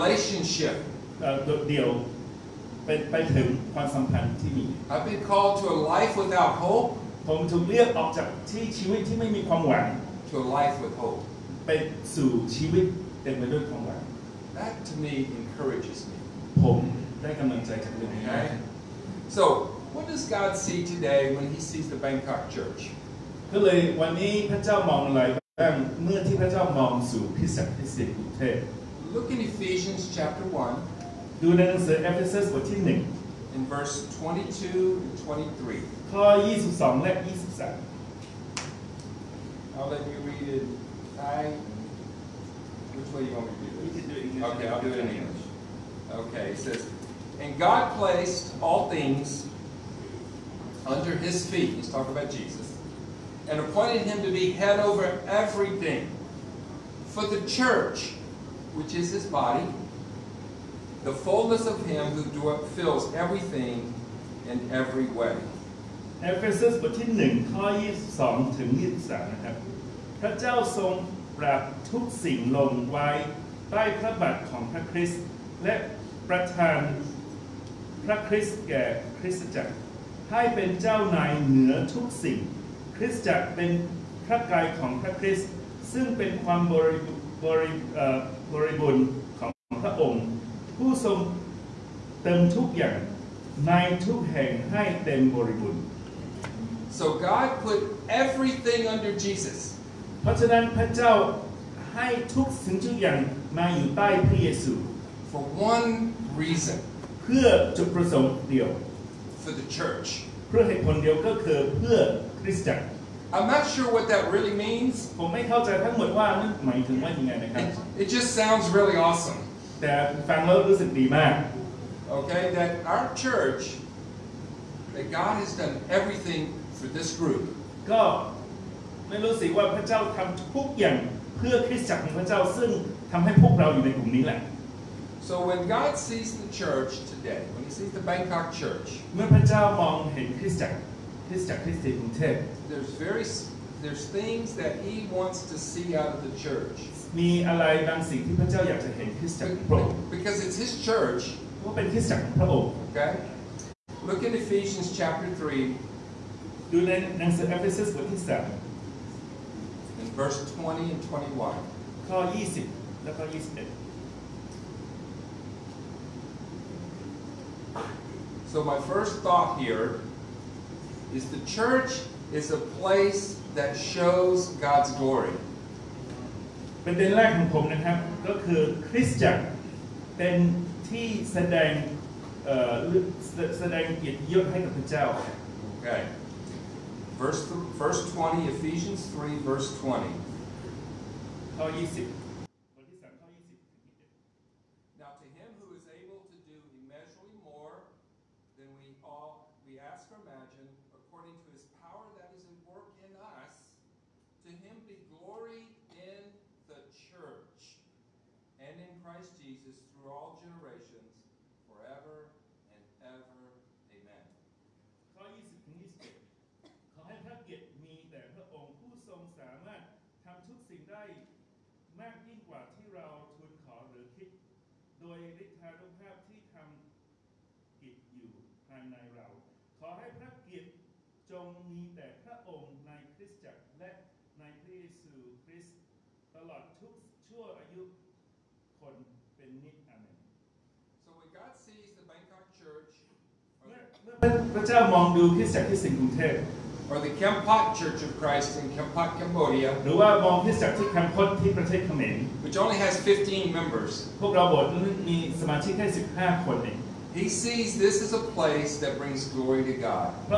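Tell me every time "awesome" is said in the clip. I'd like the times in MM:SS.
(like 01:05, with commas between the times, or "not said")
01:59.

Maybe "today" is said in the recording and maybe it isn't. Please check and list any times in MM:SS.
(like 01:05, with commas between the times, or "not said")
00:20, 02:17.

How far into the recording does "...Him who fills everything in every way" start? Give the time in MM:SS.
01:01.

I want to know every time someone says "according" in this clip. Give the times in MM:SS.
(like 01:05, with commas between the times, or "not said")
03:20.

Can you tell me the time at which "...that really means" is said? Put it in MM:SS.
01:54.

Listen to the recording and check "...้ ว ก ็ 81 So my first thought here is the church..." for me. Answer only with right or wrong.
wrong.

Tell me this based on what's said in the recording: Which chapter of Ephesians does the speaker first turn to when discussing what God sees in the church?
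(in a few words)
Chapter 1.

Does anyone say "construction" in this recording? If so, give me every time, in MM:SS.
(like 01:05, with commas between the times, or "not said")
not said.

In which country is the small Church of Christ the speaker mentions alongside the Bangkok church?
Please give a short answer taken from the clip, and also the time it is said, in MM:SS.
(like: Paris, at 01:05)
Cambodia, at 04:09.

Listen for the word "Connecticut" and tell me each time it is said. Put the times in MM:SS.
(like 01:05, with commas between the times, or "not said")
not said.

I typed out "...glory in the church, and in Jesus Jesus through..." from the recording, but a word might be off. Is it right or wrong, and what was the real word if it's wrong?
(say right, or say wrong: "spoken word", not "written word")
wrong: "Christ", not "Jesus".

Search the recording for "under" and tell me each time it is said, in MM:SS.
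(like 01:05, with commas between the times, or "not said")
00:50, 01:38.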